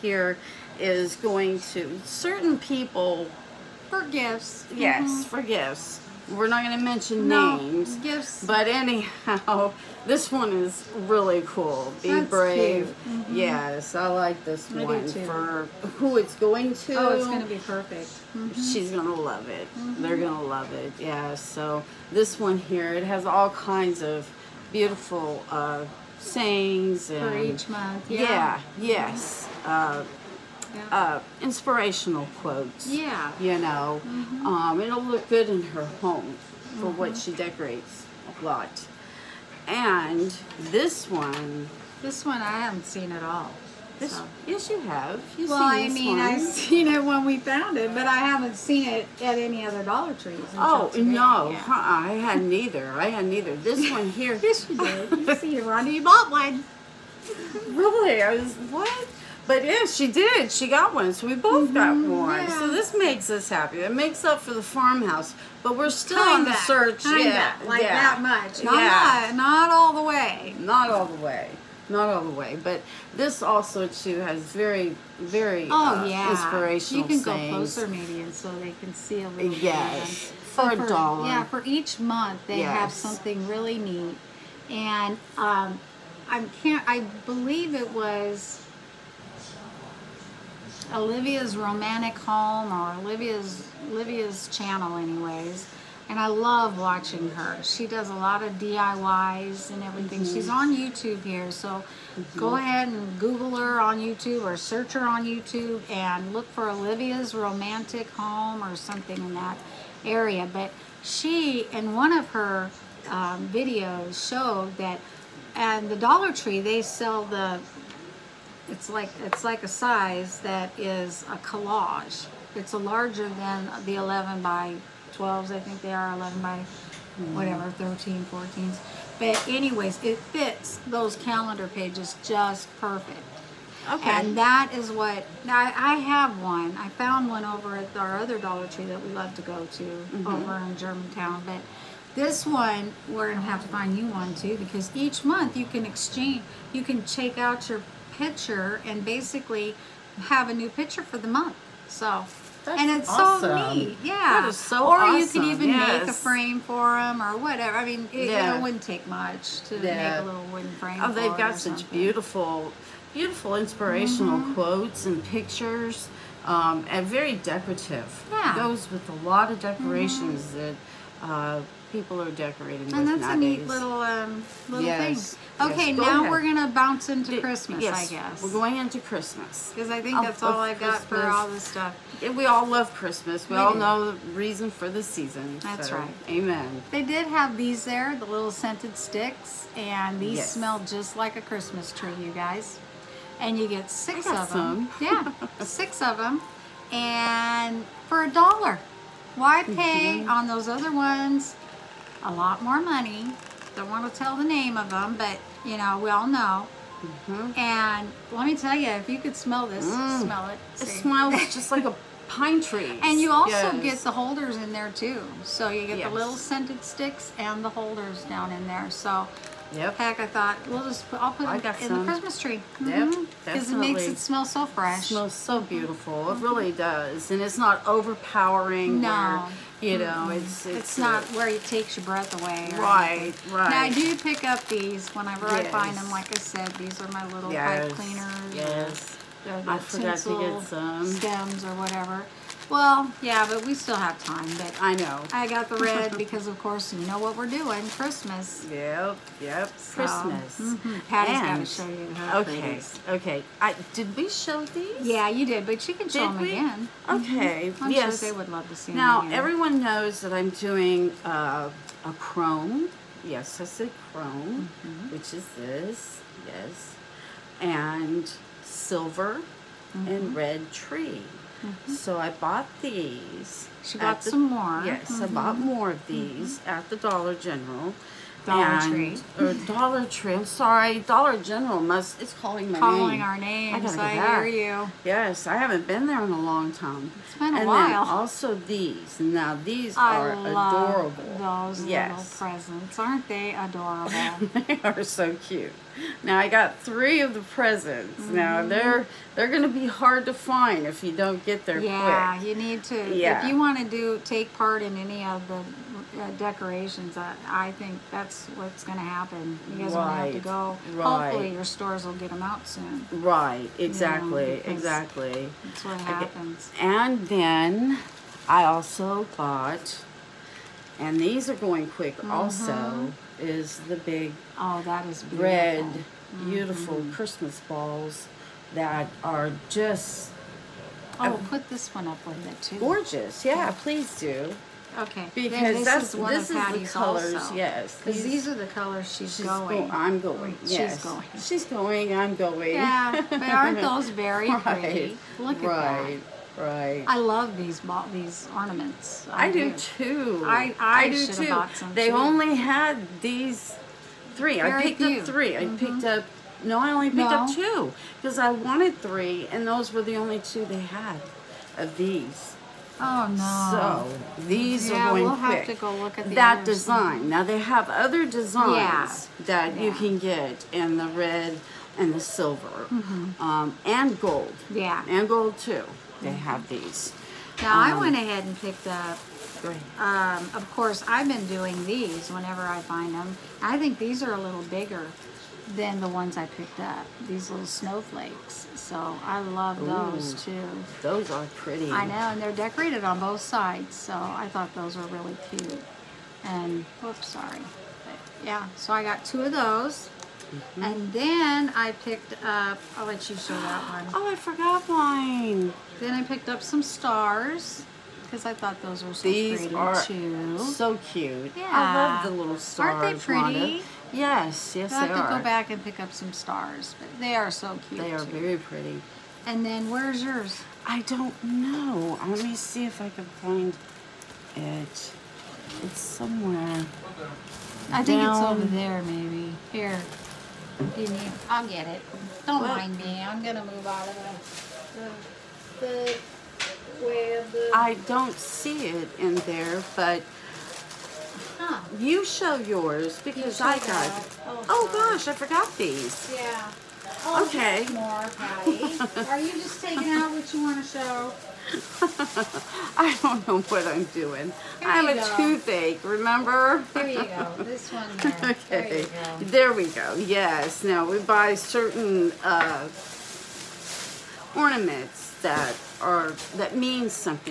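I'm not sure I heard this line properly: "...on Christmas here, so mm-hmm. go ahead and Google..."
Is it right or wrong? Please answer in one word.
wrong.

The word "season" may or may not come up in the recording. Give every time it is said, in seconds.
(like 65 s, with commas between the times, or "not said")
185 s.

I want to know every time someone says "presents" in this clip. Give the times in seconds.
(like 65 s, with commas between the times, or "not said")
292 s, 297 s.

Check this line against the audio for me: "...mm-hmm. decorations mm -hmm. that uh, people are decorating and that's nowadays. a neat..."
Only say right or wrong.
right.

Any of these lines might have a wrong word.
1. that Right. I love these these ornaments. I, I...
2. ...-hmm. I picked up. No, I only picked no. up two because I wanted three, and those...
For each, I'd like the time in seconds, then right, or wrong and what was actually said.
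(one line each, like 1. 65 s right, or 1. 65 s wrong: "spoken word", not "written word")
1. 346 s right
2. 355 s right.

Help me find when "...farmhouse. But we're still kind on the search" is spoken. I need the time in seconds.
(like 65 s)
64 s.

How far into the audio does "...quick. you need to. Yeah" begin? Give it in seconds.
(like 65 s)
302 s.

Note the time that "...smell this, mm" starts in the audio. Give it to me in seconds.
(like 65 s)
209 s.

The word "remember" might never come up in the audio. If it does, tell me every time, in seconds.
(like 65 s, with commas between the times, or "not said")
456 s.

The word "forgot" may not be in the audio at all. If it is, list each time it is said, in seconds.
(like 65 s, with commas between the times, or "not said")
239 s, 404 s, 445 s.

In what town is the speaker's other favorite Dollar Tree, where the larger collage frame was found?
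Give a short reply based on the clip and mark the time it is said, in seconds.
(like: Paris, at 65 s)
Germantown, at 140 s.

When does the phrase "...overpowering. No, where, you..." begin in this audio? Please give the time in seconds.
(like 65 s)
227 s.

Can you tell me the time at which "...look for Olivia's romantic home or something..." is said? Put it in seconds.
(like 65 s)
106 s.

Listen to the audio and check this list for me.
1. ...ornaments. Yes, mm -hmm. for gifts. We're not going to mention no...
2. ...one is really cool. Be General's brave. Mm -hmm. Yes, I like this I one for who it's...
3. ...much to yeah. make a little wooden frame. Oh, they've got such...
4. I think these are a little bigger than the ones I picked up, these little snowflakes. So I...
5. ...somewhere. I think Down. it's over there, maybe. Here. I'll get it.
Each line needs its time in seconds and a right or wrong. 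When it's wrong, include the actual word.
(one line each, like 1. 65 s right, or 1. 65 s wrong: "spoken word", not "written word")
1. 4 s wrong: "gifts", not "ornaments"
2. 10 s wrong: "That", not "General"
3. 159 s right
4. 383 s right
5. 425 s right.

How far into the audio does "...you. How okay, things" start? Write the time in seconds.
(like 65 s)
251 s.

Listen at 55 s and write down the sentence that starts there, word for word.
You see, Rhonda, you bought one.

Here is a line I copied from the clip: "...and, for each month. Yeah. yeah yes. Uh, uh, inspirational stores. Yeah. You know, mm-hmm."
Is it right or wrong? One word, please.
wrong.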